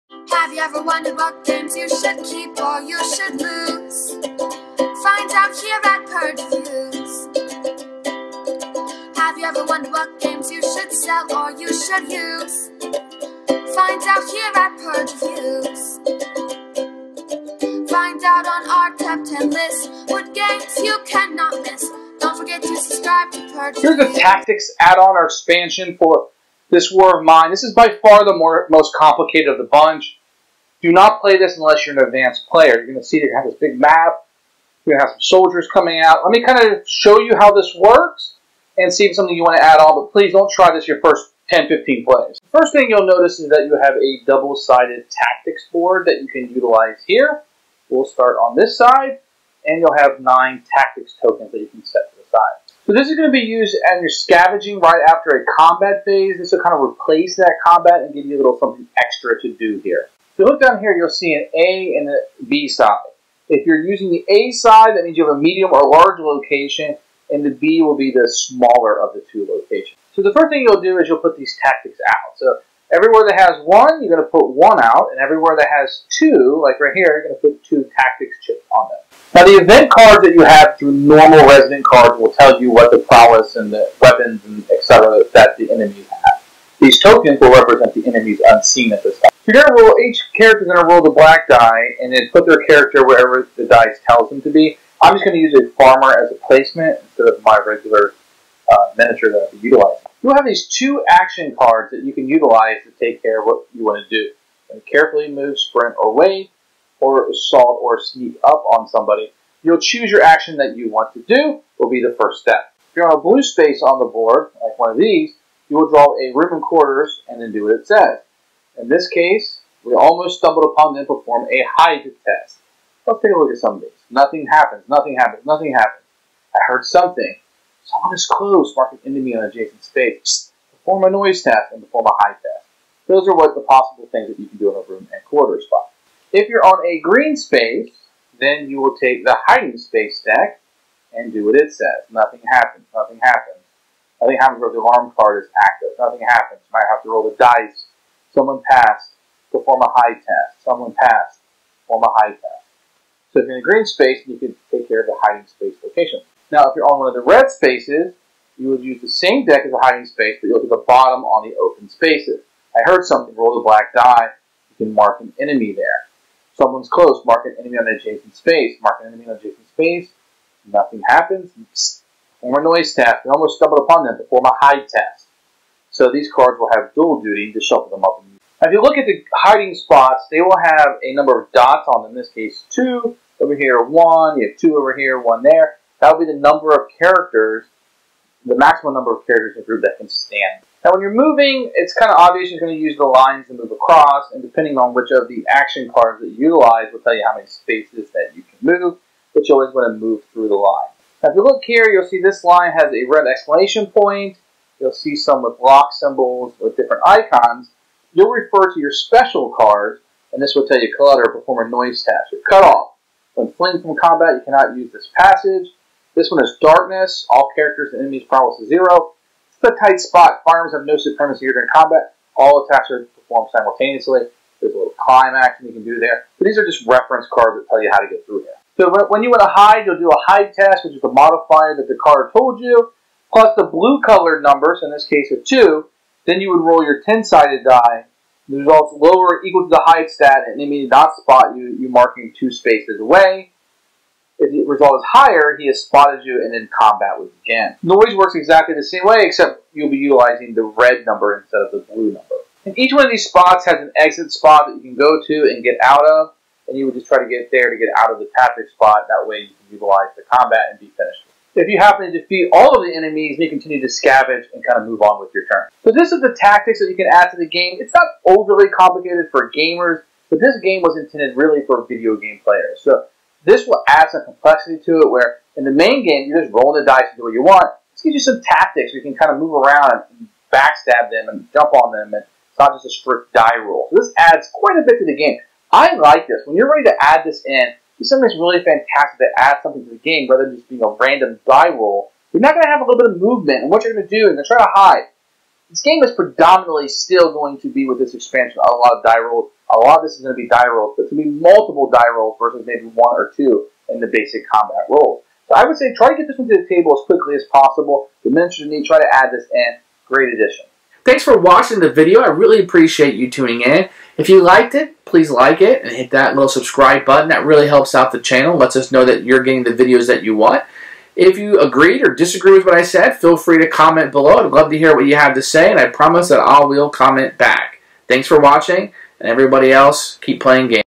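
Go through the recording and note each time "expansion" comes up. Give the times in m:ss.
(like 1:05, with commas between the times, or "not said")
0:25, 4:58.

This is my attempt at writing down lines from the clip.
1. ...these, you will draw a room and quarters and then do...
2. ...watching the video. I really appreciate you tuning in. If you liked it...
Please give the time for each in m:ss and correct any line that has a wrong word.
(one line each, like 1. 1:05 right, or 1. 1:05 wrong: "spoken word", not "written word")
1. 1:54 right
2. 5:11 right.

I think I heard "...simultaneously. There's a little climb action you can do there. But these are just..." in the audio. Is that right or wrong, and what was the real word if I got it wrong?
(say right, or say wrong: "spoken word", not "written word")
right.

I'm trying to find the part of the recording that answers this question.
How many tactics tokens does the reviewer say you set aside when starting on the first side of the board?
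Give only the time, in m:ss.
0:50.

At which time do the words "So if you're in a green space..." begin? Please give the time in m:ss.
2:33.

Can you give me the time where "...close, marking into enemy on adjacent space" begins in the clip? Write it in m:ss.
2:08.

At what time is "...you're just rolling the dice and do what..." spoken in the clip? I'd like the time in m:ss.
4:36.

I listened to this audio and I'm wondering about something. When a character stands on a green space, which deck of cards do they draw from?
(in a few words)
hiding space deck.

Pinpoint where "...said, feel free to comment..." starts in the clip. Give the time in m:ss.
5:22.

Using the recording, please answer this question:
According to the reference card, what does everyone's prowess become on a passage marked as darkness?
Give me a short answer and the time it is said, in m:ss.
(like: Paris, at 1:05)
0, at 3:38.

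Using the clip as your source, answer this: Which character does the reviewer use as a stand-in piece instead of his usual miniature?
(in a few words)
farmer.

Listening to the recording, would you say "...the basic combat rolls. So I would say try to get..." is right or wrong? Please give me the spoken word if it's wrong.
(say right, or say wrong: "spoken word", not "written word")
right.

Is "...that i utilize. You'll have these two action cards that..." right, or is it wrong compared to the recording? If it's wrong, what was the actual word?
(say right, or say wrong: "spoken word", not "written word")
right.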